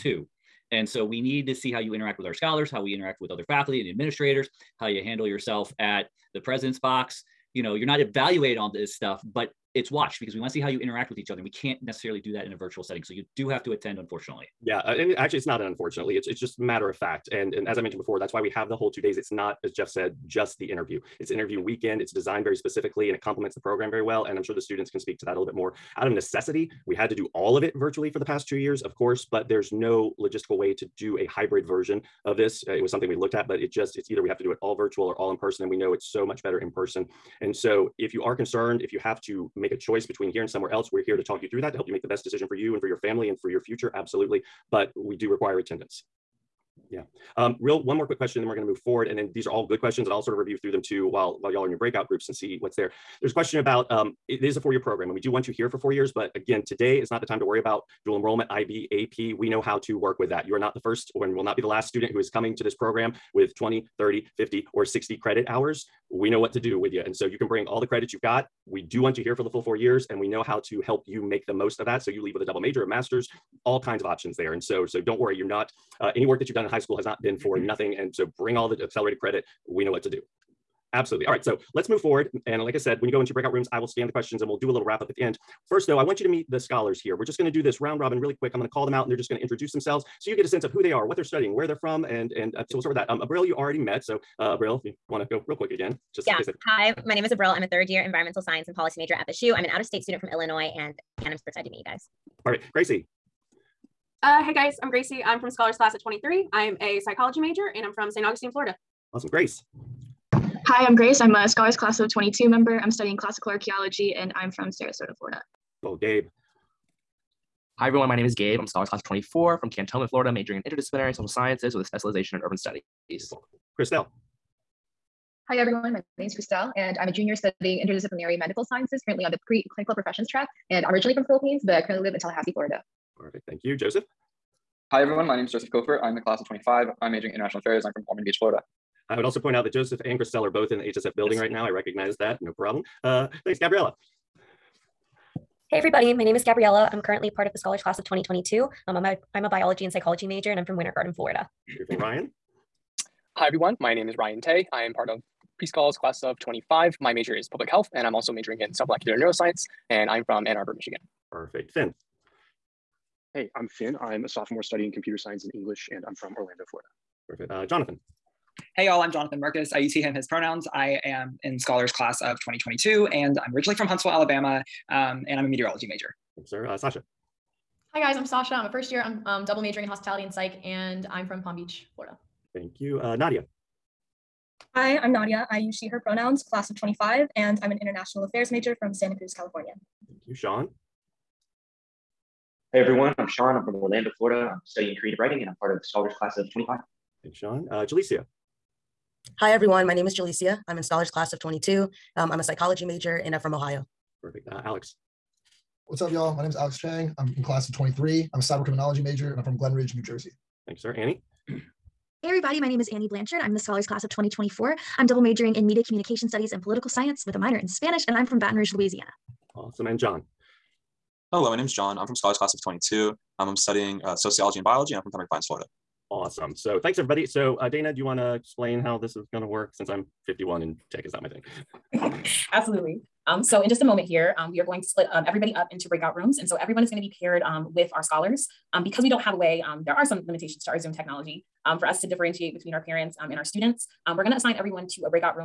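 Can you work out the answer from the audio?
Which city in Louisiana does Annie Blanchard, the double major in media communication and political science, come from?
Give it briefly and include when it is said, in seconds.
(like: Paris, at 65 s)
Baton Rouge, at 218 s.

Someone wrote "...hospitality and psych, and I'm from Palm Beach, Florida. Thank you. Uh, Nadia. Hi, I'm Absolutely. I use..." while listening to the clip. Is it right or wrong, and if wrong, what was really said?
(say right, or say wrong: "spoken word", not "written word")
wrong: "Nadia", not "Absolutely".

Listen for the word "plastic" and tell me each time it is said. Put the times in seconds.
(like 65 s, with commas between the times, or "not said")
not said.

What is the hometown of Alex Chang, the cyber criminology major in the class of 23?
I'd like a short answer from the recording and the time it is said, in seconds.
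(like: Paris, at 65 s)
Glen Ridge, New Jersey, at 209 s.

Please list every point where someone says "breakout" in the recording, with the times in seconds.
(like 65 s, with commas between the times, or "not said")
51 s, 83 s, 235 s.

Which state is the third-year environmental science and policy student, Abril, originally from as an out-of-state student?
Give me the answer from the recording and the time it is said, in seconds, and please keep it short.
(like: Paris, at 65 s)
Illinois, at 100 s.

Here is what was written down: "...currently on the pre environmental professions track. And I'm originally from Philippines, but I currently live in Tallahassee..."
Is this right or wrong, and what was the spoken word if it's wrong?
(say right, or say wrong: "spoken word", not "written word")
wrong: "clinical", not "environmental".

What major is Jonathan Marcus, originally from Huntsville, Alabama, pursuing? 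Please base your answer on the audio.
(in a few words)
Meteorology.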